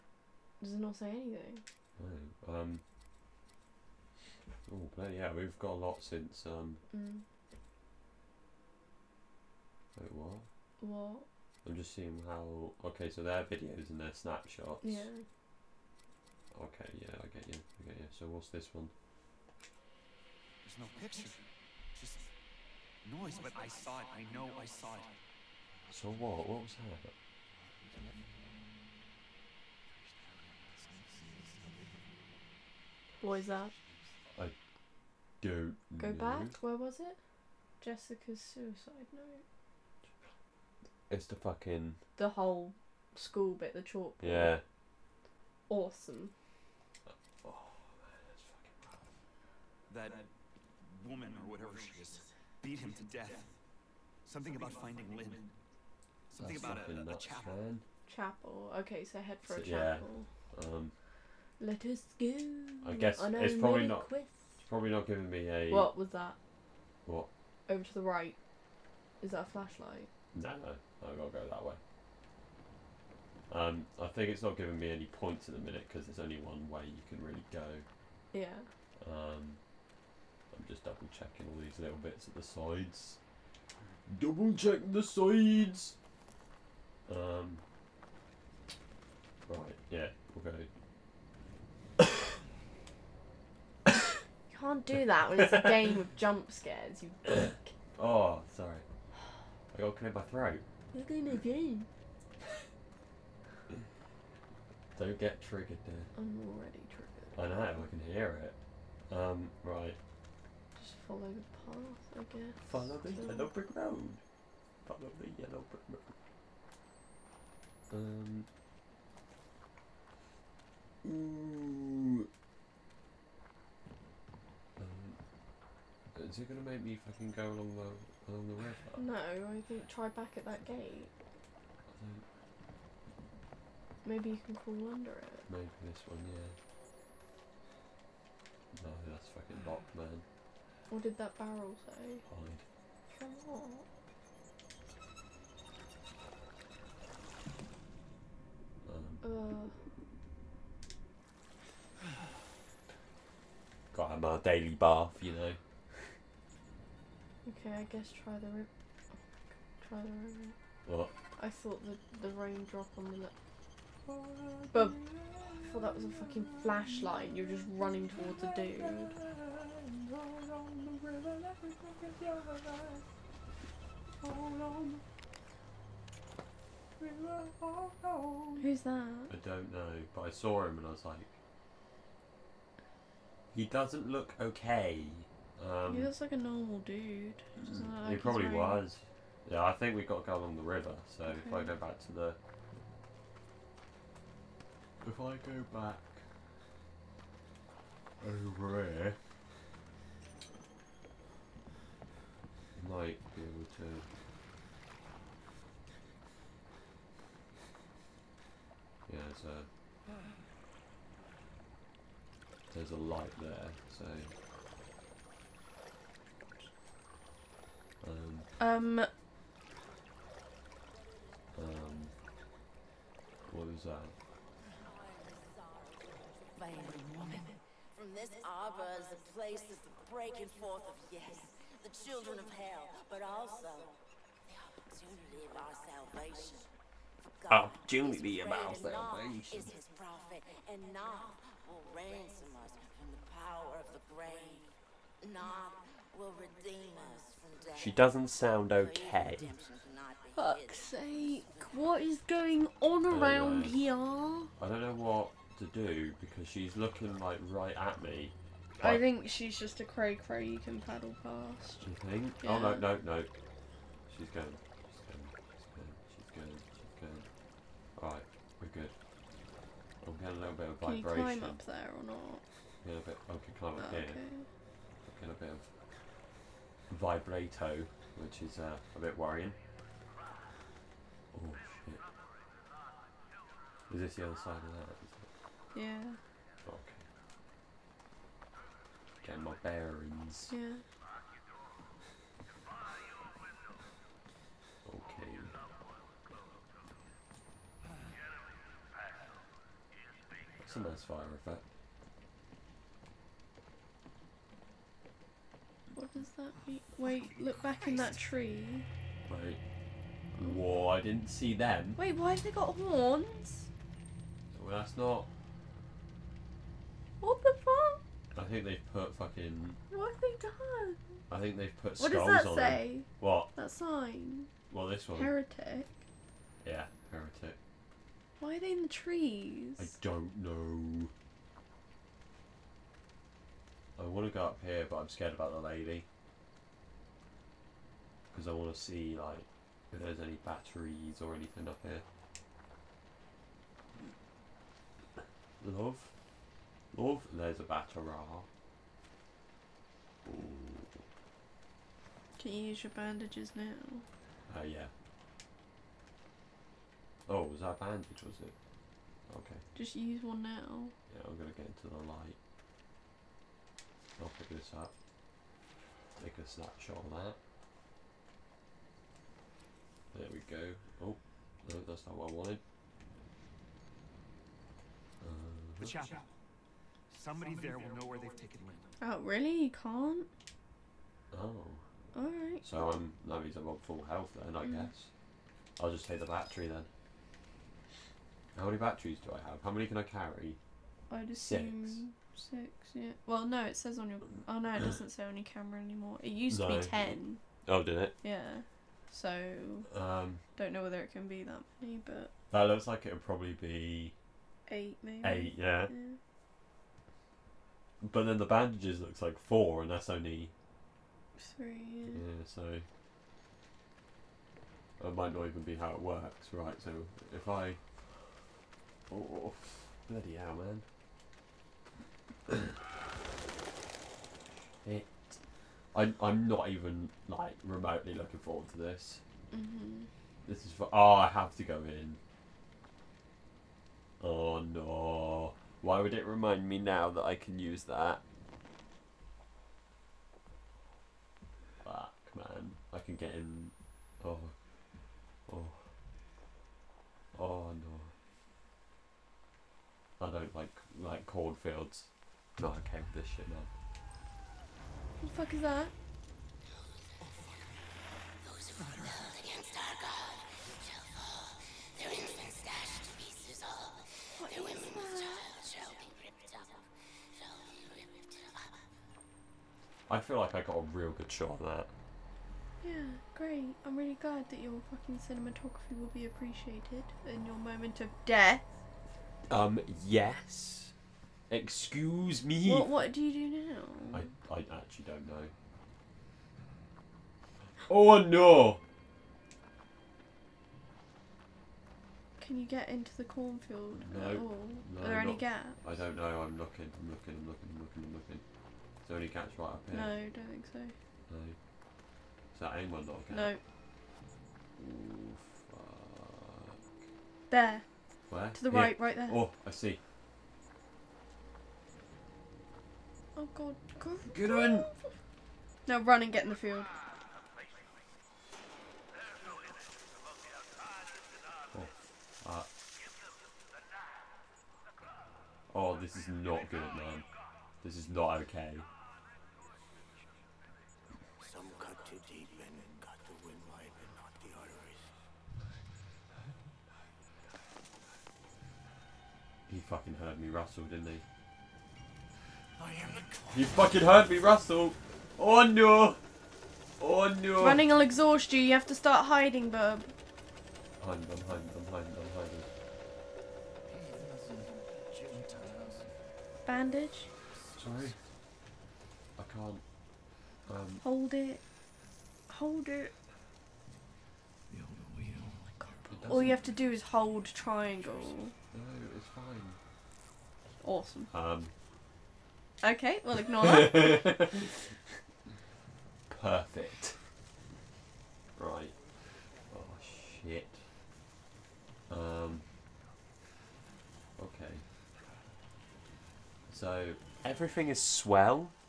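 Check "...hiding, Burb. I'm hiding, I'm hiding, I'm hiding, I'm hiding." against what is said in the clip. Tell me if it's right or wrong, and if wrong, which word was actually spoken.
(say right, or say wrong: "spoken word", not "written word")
right.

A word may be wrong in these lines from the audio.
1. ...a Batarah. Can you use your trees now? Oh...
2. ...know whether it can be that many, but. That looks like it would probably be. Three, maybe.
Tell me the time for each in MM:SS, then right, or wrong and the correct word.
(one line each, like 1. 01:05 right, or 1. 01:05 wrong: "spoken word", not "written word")
1. 05:47 wrong: "bandages", not "trees"
2. 06:40 wrong: "Eight", not "Three".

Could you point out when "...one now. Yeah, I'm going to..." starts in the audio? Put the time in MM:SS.
06:00.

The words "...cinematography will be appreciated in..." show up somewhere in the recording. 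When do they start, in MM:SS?
07:55.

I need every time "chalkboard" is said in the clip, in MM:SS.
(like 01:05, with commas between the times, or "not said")
00:43.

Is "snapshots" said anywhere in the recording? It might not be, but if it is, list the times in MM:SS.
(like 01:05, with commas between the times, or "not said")
00:14, 06:06.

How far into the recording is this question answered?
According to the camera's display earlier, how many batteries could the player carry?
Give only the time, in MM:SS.
06:36.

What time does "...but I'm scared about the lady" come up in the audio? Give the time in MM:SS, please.
05:34.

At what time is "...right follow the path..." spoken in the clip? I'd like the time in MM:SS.
01:49.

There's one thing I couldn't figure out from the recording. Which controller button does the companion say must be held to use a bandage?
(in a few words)
Triangle.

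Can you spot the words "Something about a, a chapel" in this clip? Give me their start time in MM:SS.
00:56.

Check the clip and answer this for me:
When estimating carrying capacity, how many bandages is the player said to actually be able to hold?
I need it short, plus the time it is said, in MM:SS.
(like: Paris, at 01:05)
3, at 06:51.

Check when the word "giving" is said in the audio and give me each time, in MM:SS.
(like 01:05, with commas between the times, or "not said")
01:05, 01:14.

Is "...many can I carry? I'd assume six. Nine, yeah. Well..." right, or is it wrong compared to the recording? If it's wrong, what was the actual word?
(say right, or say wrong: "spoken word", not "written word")
wrong: "Six", not "Nine".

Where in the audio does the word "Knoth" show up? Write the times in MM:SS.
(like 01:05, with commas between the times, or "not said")
04:00, 04:05.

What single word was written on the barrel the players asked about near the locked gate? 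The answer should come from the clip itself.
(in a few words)
Hide.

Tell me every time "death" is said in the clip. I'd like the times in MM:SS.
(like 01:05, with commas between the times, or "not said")
00:53, 04:07, 07:58.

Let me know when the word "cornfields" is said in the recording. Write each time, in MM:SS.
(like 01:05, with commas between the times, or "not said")
07:31, 08:13.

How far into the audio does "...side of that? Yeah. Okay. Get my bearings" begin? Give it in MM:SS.
04:44.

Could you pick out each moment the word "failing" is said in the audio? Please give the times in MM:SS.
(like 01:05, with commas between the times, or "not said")
03:46.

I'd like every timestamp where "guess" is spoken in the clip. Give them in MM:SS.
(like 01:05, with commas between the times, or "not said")
01:02, 01:52, 02:37, 06:24.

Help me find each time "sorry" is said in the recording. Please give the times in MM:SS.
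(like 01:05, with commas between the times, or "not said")
01:38, 09:17.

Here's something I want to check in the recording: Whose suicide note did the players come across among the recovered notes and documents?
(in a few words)
Jessica.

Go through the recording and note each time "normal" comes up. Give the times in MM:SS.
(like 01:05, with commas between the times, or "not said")
03:06.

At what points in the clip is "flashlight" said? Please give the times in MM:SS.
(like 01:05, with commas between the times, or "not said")
01:09, 02:46.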